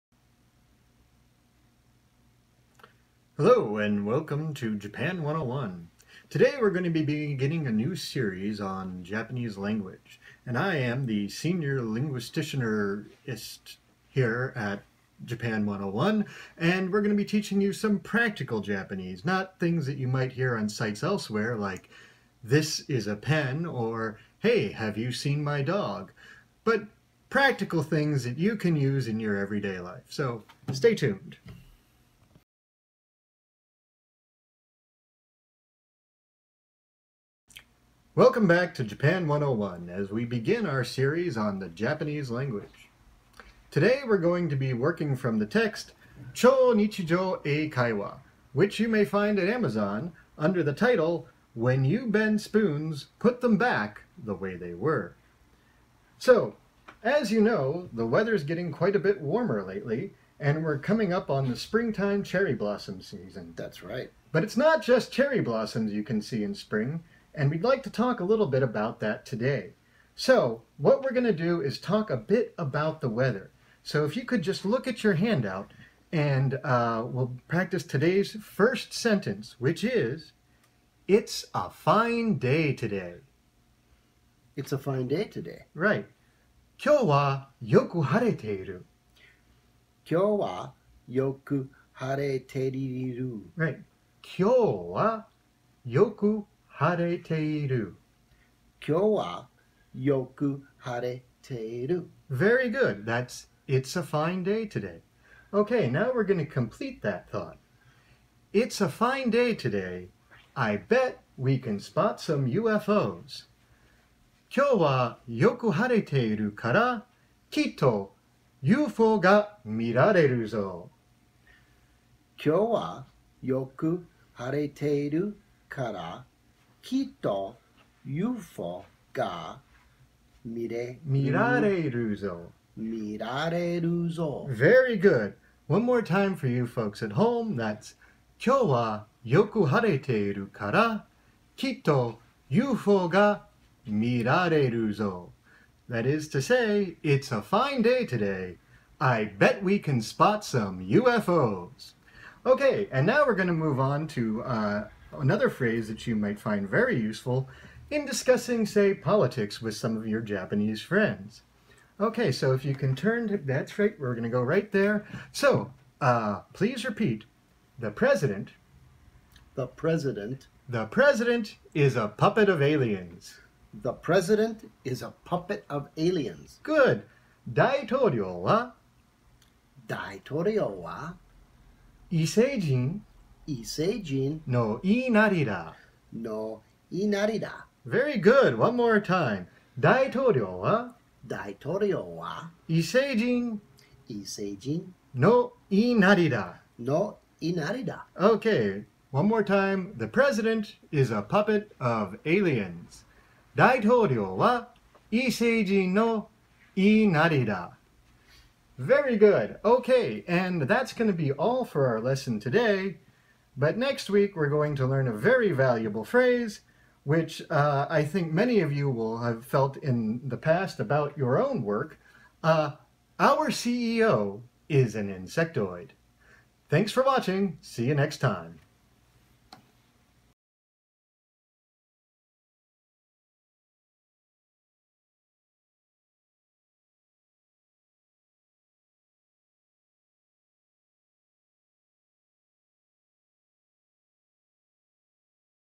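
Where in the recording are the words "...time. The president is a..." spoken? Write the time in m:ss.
3:19.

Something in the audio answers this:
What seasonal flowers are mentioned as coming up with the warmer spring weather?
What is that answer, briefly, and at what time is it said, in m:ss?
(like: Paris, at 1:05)
Cherry blossoms, at 1:02.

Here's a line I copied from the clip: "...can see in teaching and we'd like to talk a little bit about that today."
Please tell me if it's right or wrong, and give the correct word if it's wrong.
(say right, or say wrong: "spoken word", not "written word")
wrong: "spring", not "teaching".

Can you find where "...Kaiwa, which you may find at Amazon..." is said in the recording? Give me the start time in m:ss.
0:47.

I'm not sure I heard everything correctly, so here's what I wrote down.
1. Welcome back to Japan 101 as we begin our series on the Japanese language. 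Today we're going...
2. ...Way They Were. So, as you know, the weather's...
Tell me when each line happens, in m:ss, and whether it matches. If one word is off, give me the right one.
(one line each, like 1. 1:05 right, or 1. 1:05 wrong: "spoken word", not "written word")
1. 0:38 right
2. 0:54 right.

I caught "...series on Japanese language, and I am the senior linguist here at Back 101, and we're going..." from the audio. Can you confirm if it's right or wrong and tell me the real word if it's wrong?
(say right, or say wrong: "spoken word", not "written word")
wrong: "Japan", not "Back".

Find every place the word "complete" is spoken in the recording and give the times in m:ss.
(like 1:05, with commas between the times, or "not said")
1:46.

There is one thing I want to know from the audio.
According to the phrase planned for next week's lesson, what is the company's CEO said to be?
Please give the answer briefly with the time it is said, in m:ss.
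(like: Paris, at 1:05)
An insectoid, at 3:45.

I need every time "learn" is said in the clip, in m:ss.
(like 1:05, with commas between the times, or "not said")
3:34.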